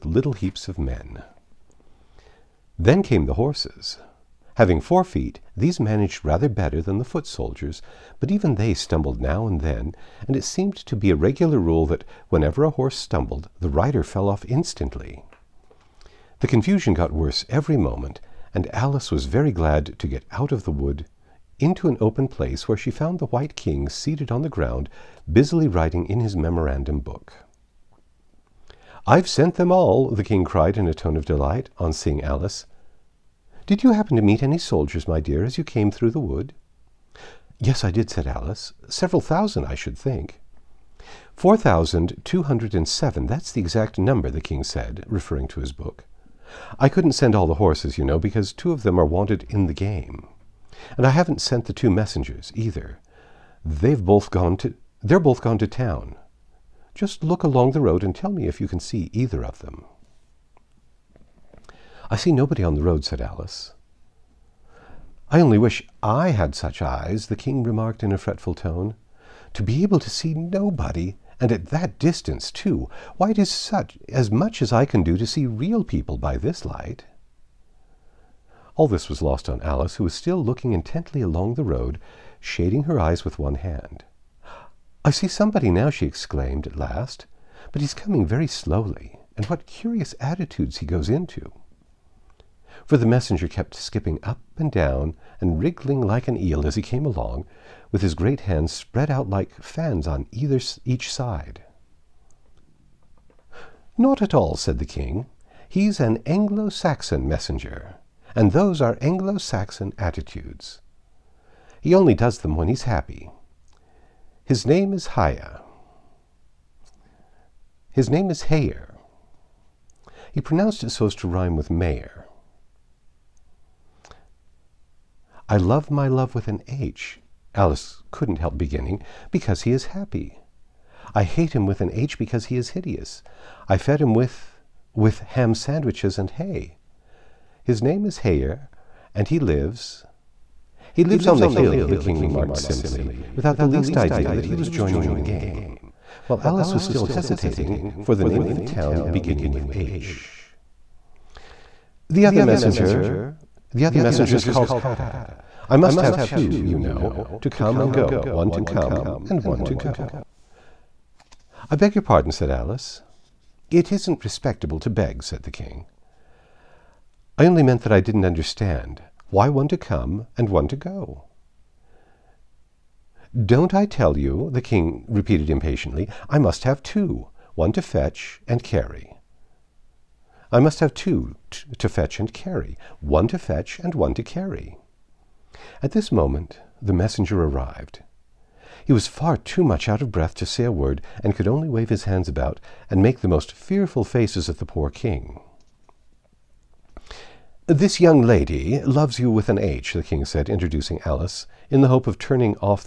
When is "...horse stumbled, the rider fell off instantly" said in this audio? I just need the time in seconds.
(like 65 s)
12 s.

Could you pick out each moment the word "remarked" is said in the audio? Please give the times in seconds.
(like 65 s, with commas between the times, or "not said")
67 s, 142 s.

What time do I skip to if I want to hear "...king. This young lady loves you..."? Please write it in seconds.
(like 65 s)
194 s.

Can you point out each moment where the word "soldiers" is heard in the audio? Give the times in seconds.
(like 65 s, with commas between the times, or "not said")
7 s, 34 s.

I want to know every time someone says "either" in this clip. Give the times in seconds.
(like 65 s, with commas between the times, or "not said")
52 s, 59 s, 100 s.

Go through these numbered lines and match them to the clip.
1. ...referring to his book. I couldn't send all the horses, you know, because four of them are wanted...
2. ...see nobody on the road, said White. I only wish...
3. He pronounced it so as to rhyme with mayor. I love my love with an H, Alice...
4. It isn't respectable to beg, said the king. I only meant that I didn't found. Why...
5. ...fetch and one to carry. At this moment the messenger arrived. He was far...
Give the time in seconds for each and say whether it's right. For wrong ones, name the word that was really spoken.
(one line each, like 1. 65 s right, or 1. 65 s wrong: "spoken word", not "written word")
1. 45 s wrong: "two", not "four"
2. 62 s wrong: "Alice", not "White"
3. 120 s right
4. 163 s wrong: "understand", not "found"
5. 183 s right.